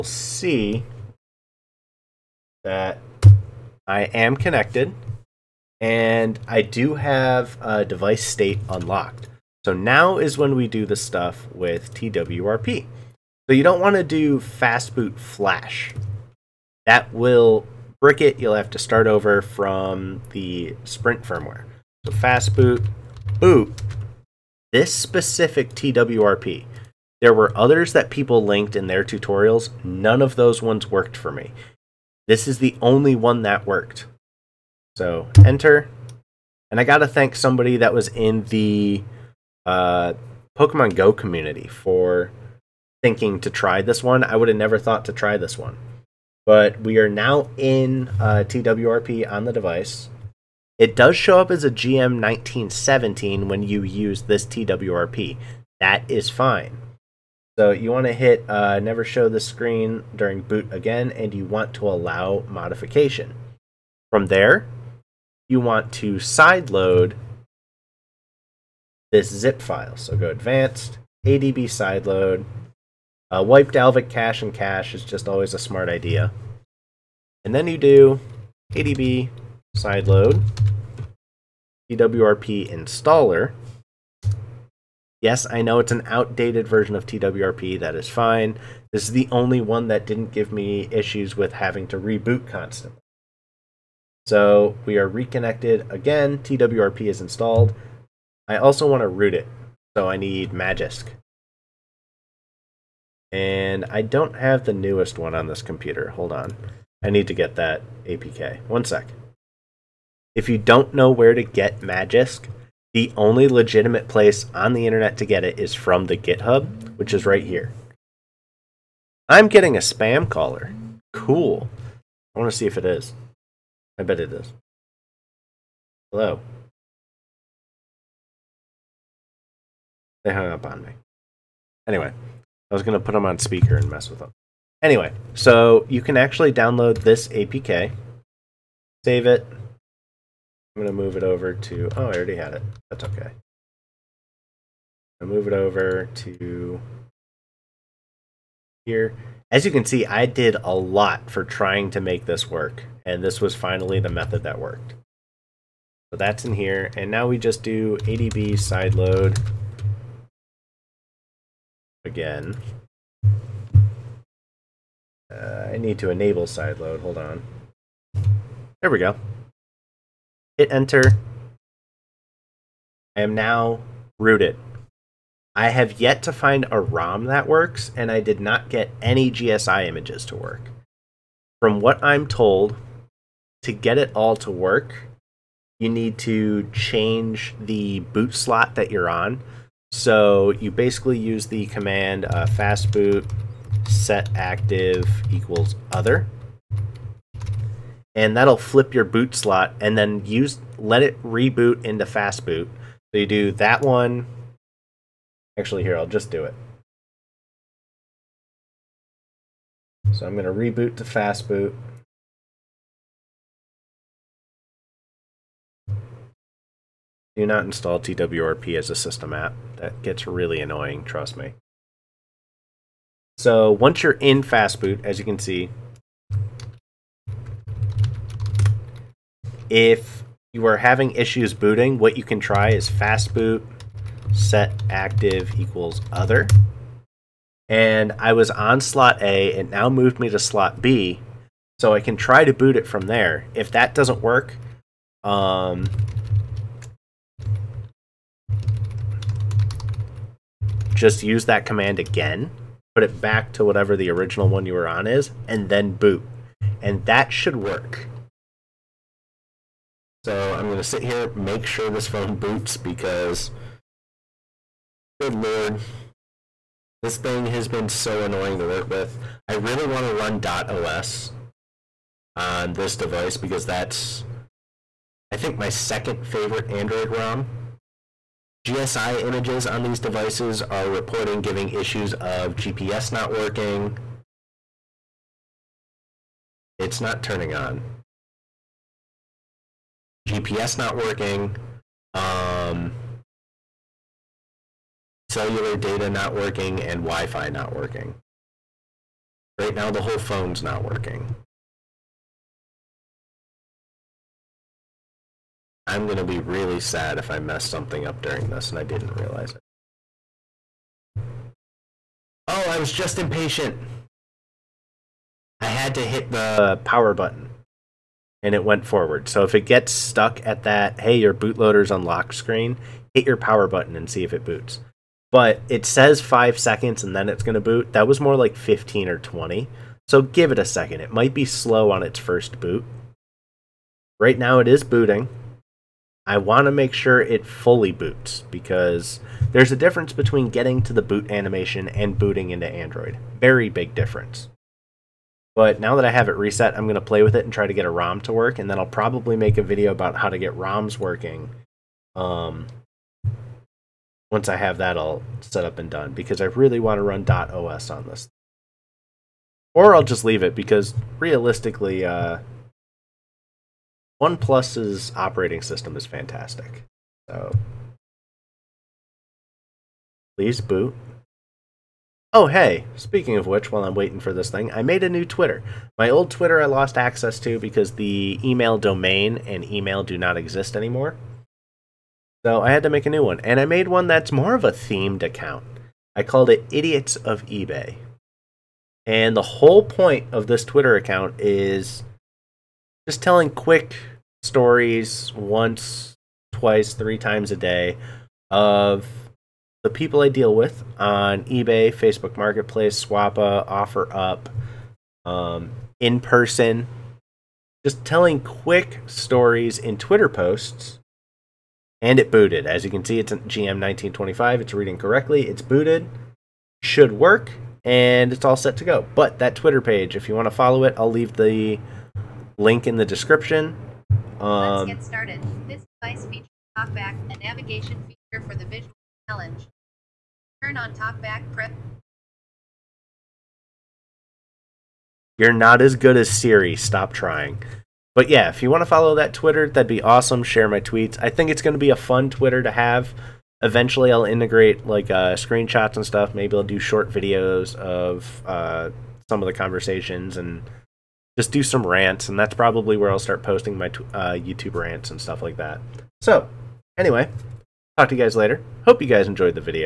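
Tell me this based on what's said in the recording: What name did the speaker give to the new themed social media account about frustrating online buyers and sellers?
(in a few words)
Idiots of eBay.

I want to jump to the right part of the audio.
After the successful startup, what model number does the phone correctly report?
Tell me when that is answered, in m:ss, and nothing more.
6:53.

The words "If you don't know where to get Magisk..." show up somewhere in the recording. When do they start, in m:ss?
1:50.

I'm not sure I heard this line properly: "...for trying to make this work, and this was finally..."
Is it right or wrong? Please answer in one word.
right.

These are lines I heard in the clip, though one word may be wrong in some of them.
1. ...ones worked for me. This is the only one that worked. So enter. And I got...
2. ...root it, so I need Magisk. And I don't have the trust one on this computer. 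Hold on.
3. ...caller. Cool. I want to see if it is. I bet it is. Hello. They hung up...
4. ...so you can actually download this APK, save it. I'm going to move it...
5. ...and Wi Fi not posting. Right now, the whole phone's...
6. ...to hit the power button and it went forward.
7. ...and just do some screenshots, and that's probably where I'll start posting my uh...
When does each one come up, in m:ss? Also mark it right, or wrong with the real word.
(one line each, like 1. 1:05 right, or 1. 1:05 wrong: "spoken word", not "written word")
1. 0:30 right
2. 1:39 wrong: "newest", not "trust"
3. 2:00 right
4. 2:15 right
5. 4:56 wrong: "working", not "posting"
6. 5:15 right
7. 7:30 wrong: "rants", not "screenshots".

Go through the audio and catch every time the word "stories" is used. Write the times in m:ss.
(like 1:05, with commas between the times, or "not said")
6:34, 6:49.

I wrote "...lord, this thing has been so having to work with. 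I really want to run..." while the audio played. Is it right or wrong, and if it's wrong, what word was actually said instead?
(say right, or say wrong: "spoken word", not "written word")
wrong: "annoying", not "having".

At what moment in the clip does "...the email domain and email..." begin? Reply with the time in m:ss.
6:17.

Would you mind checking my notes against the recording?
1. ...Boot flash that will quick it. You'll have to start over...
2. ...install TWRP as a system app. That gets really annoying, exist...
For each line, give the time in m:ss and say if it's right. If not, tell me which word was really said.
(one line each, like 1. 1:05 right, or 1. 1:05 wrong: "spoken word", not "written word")
1. 0:14 wrong: "brick", not "quick"
2. 3:37 wrong: "trust", not "exist".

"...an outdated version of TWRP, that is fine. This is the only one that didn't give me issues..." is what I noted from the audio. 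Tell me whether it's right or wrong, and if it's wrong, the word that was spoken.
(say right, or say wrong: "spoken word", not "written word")
right.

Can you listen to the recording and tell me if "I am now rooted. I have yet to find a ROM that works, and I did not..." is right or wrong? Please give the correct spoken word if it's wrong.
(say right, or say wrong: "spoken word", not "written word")
right.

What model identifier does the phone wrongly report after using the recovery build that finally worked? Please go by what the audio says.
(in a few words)
GM1917.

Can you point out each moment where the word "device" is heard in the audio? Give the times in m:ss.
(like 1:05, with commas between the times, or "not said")
0:07, 0:49, 4:32, 4:39, 7:06.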